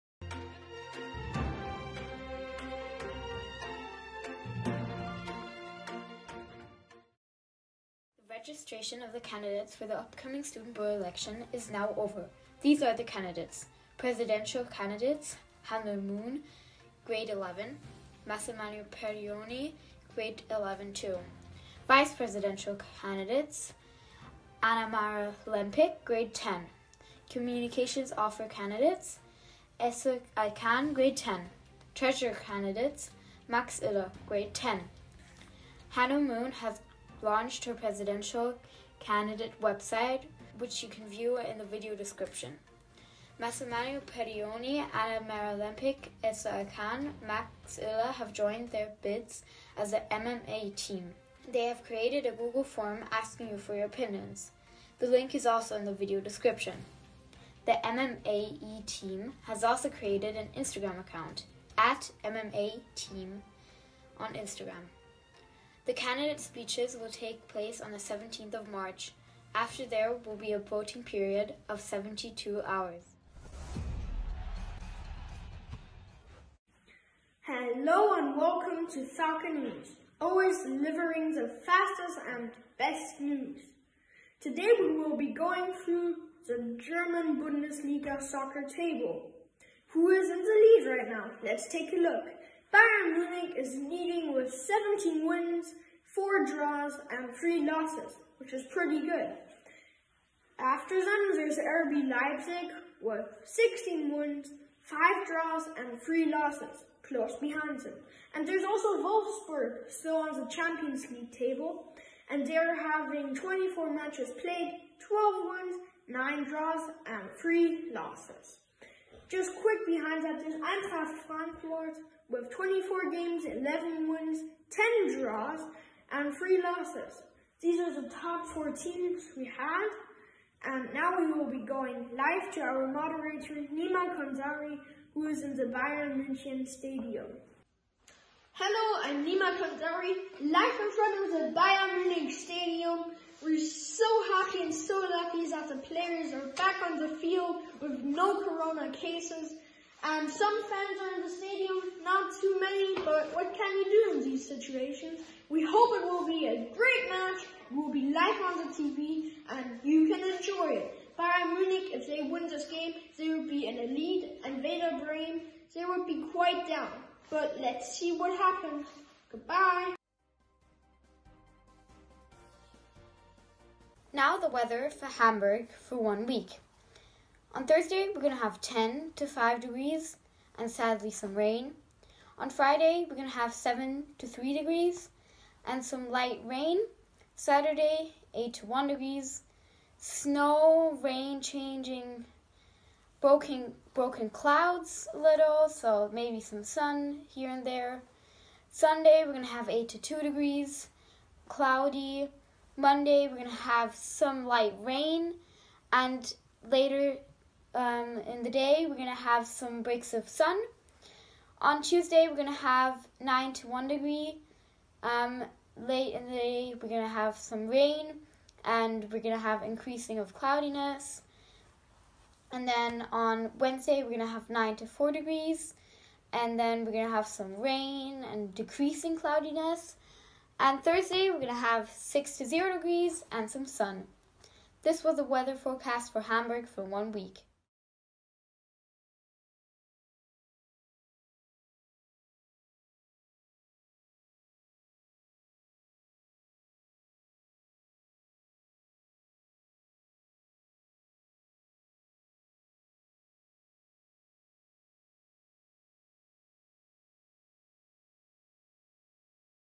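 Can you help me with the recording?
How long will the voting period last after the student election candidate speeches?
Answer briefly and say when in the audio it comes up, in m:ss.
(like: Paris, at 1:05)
72 hours, at 1:11.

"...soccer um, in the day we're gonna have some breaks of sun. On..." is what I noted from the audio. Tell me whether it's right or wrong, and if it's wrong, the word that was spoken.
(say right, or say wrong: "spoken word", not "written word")
wrong: "later", not "soccer".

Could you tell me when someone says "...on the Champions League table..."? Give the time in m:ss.
1:50.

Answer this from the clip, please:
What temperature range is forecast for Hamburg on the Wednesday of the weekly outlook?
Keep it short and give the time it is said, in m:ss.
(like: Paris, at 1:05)
9 to 4 degrees, at 3:44.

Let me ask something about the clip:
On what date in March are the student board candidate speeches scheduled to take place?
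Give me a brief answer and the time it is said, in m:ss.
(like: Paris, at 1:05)
17th of March, at 1:07.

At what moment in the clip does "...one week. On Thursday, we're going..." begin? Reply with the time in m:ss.
2:55.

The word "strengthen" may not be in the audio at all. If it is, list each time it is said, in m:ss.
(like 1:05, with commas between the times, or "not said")
not said.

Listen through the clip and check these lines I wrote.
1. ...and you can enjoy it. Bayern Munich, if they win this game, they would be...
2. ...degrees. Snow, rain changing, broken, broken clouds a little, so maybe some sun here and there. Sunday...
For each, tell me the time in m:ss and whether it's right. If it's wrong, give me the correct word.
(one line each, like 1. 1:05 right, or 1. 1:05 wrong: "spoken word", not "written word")
1. 2:39 right
2. 3:08 right.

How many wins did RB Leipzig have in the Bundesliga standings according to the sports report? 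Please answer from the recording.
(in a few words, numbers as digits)
16.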